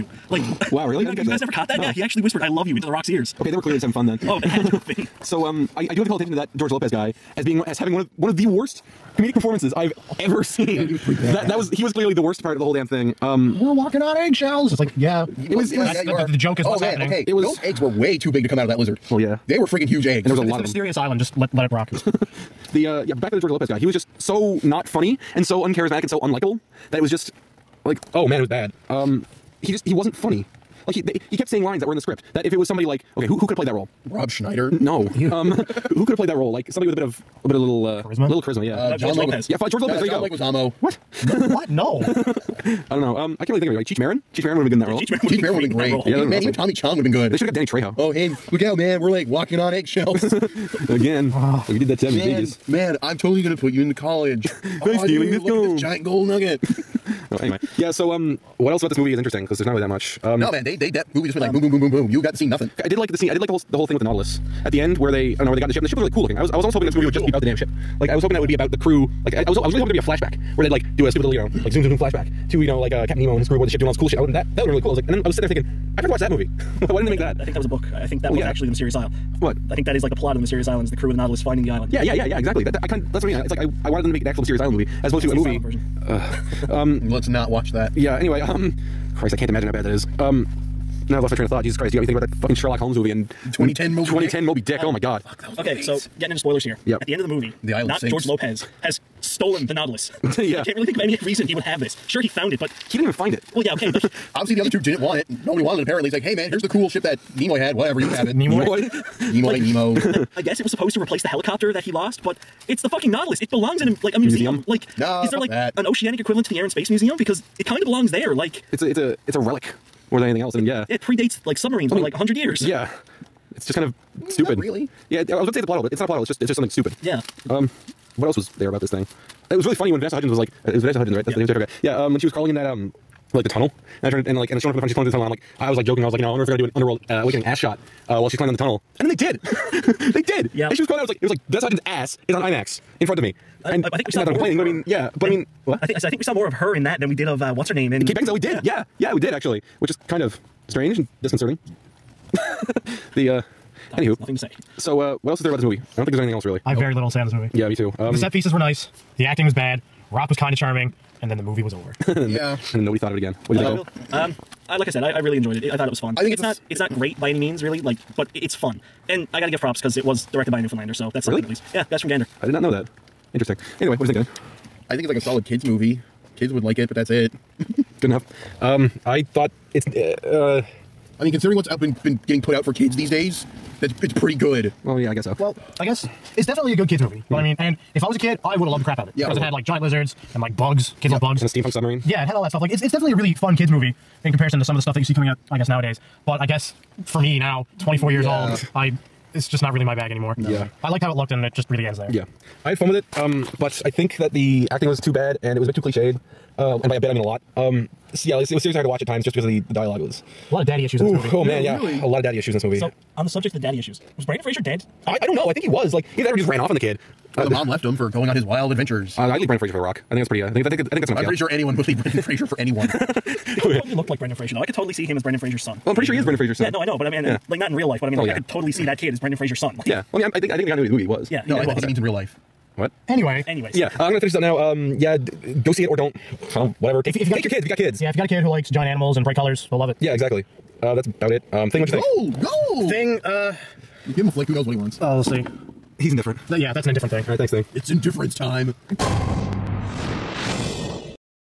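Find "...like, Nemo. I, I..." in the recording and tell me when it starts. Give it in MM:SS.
01:49.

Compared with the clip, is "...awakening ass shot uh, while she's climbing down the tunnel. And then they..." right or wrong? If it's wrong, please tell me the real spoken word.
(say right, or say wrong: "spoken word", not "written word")
right.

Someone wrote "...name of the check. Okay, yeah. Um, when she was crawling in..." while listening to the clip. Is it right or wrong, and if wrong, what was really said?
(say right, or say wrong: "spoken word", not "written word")
right.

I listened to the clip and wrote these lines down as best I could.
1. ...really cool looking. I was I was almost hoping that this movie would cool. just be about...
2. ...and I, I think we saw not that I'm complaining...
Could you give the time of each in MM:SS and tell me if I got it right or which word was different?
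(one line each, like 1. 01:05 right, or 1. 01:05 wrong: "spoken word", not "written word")
1. 01:06 right
2. 02:23 right.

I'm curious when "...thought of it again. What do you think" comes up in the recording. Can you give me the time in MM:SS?
02:42.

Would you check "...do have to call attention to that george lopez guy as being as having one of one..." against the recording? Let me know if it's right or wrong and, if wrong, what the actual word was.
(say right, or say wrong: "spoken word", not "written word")
right.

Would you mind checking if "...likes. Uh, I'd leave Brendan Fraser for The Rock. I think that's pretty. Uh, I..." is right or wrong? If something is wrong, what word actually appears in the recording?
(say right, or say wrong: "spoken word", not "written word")
wrong: "adventures", not "likes".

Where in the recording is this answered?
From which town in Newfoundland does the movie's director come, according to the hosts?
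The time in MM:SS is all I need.
02:52.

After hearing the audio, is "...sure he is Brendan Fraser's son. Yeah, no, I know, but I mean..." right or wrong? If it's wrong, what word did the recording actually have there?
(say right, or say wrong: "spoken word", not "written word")
right.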